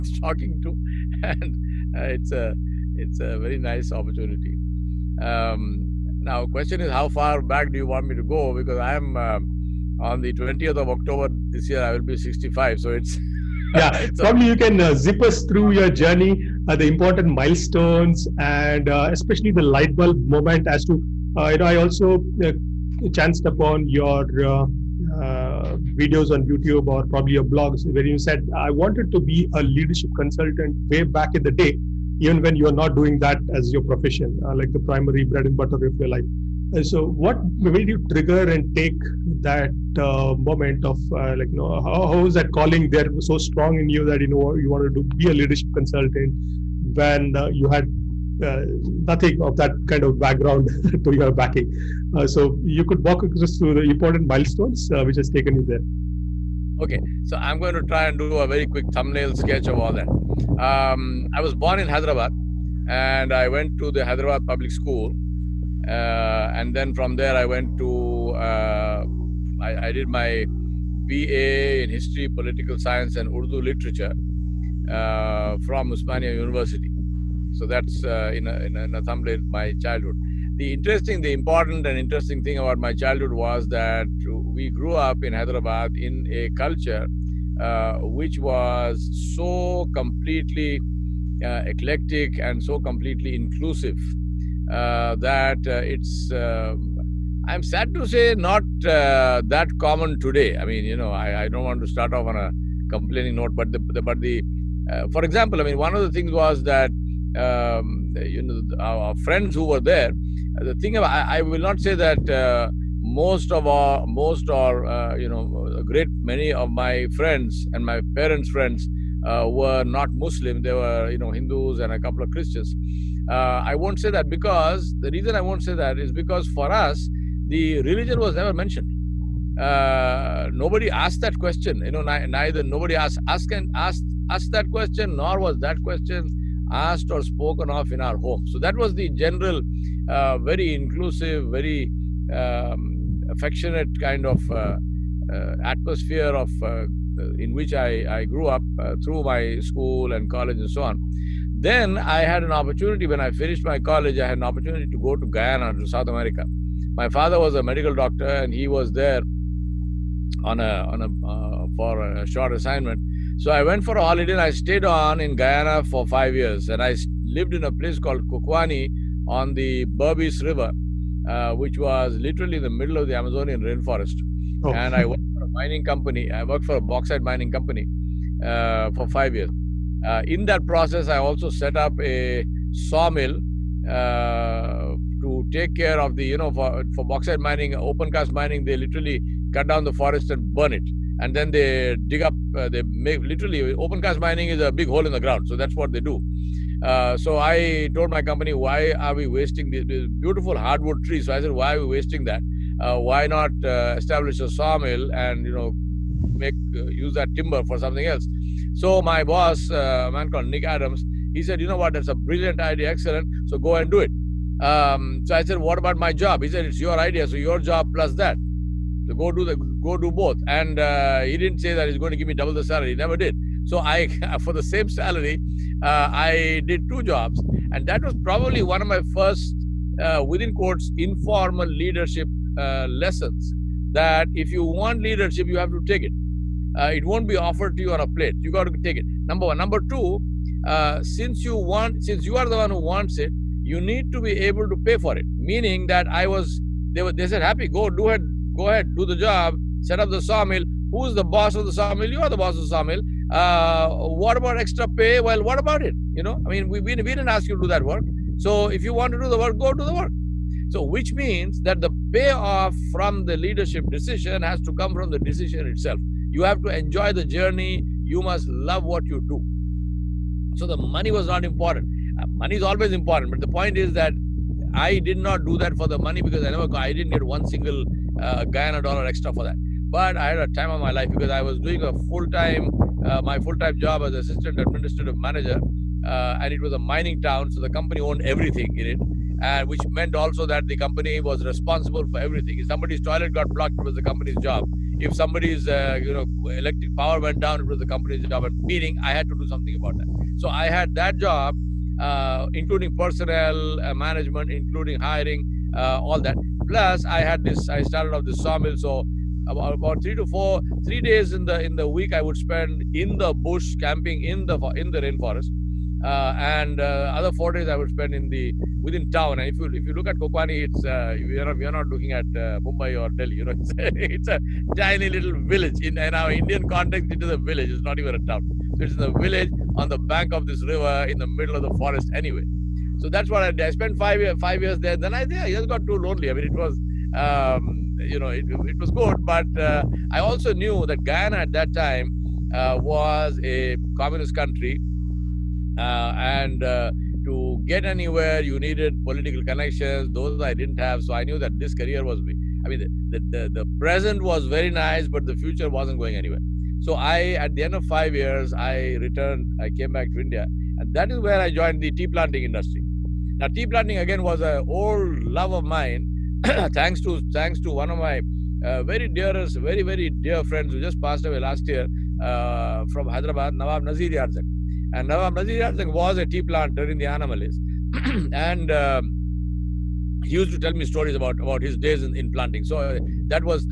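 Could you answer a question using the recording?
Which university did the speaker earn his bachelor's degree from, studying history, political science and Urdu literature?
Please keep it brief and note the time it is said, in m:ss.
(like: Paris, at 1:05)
Osmania University, at 1:15.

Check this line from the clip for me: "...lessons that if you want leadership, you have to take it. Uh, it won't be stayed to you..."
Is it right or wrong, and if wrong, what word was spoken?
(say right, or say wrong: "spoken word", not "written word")
wrong: "offered", not "stayed".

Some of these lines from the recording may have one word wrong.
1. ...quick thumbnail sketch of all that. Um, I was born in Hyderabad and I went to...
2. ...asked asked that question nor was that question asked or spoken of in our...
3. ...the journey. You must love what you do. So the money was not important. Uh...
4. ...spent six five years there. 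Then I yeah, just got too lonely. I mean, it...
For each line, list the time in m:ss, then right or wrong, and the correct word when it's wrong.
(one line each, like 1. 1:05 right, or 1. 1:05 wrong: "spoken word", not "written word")
1. 0:58 right
2. 2:13 right
3. 4:27 right
4. 5:33 wrong: "five", not "six".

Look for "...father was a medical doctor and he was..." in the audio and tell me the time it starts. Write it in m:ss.
2:37.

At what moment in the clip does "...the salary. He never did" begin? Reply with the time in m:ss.
3:42.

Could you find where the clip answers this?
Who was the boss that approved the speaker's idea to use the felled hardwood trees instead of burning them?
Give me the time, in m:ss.
3:30.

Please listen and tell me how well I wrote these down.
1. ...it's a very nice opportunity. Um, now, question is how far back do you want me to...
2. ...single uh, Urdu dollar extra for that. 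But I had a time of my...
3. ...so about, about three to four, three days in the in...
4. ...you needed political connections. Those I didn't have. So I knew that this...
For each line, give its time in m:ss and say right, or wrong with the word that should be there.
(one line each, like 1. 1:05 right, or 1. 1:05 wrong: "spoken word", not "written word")
1. 0:03 right
2. 4:37 wrong: "Guyana", not "Urdu"
3. 5:08 right
4. 5:48 right.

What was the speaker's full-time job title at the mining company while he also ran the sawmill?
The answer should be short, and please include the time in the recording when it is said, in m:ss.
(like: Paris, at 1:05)
Assistant administrative manager, at 4:44.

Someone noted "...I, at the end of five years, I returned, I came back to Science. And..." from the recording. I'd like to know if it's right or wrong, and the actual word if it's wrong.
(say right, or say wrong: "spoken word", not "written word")
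wrong: "India", not "Science".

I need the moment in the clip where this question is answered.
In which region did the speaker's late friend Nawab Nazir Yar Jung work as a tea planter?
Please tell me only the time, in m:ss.
6:17.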